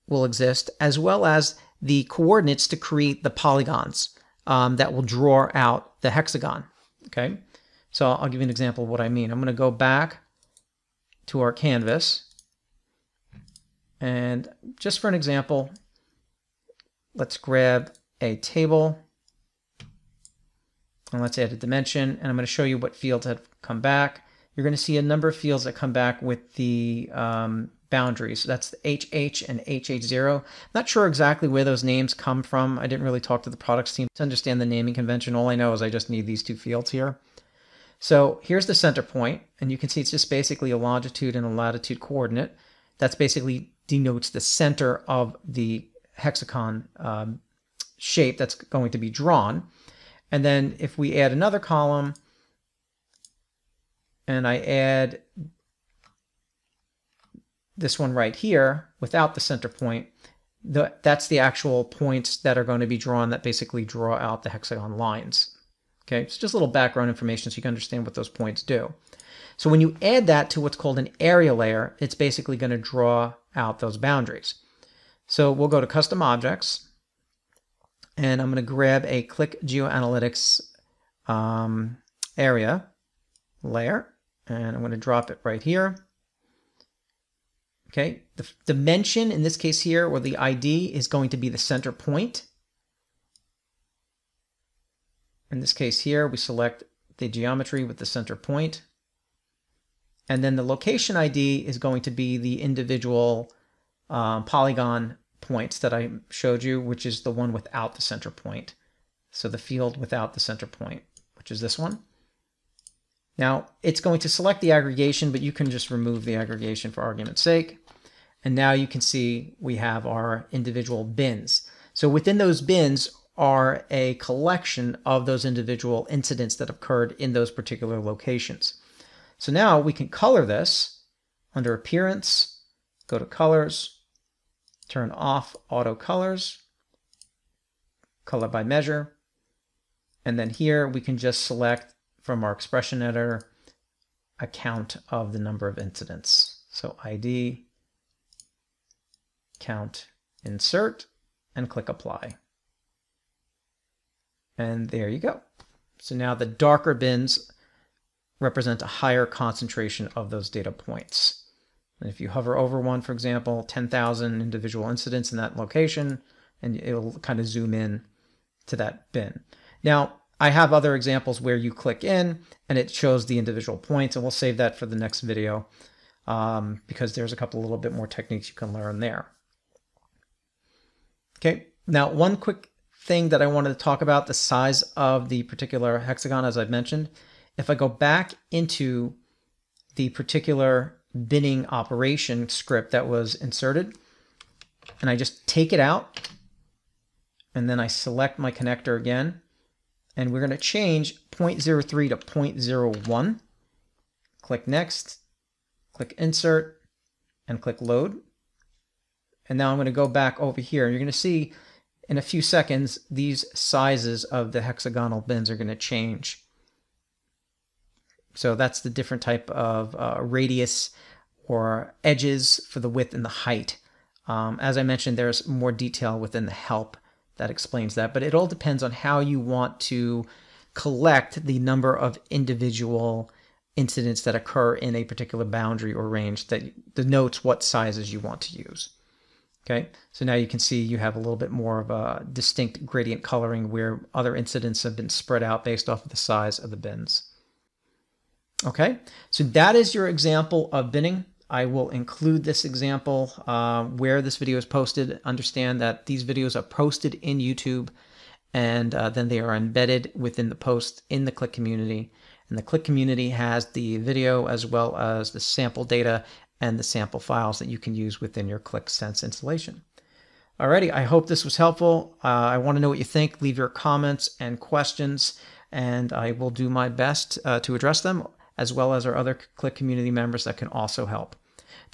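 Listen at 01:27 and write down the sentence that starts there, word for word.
Okay, the dimension in this case here, or the ID, is going to be the center point.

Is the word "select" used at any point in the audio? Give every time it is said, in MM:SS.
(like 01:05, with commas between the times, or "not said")
01:36, 01:54, 02:21, 03:17.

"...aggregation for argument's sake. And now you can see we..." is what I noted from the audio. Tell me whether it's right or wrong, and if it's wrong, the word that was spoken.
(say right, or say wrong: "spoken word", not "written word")
right.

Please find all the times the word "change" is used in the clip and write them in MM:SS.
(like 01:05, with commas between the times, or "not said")
03:20, 03:35.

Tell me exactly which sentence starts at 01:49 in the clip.
So the field without the center point, which is this one.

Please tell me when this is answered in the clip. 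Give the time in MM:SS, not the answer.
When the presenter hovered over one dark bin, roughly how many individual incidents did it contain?
02:43.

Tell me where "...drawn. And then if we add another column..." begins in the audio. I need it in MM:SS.
00:49.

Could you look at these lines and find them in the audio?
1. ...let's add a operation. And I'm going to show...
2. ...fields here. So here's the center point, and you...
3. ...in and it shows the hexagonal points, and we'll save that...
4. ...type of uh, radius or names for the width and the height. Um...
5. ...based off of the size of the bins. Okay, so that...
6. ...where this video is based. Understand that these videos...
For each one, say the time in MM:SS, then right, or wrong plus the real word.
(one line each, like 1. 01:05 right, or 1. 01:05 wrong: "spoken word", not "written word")
1. 00:21 wrong: "dimension", not "operation"
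2. 00:36 right
3. 02:52 wrong: "individual", not "hexagonal"
4. 03:39 wrong: "edges", not "names"
5. 04:05 right
6. 04:13 wrong: "posted", not "based".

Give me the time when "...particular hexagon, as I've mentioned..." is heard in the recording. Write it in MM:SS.
03:05.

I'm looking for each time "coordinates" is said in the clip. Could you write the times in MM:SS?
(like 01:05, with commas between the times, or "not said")
00:02, 00:41.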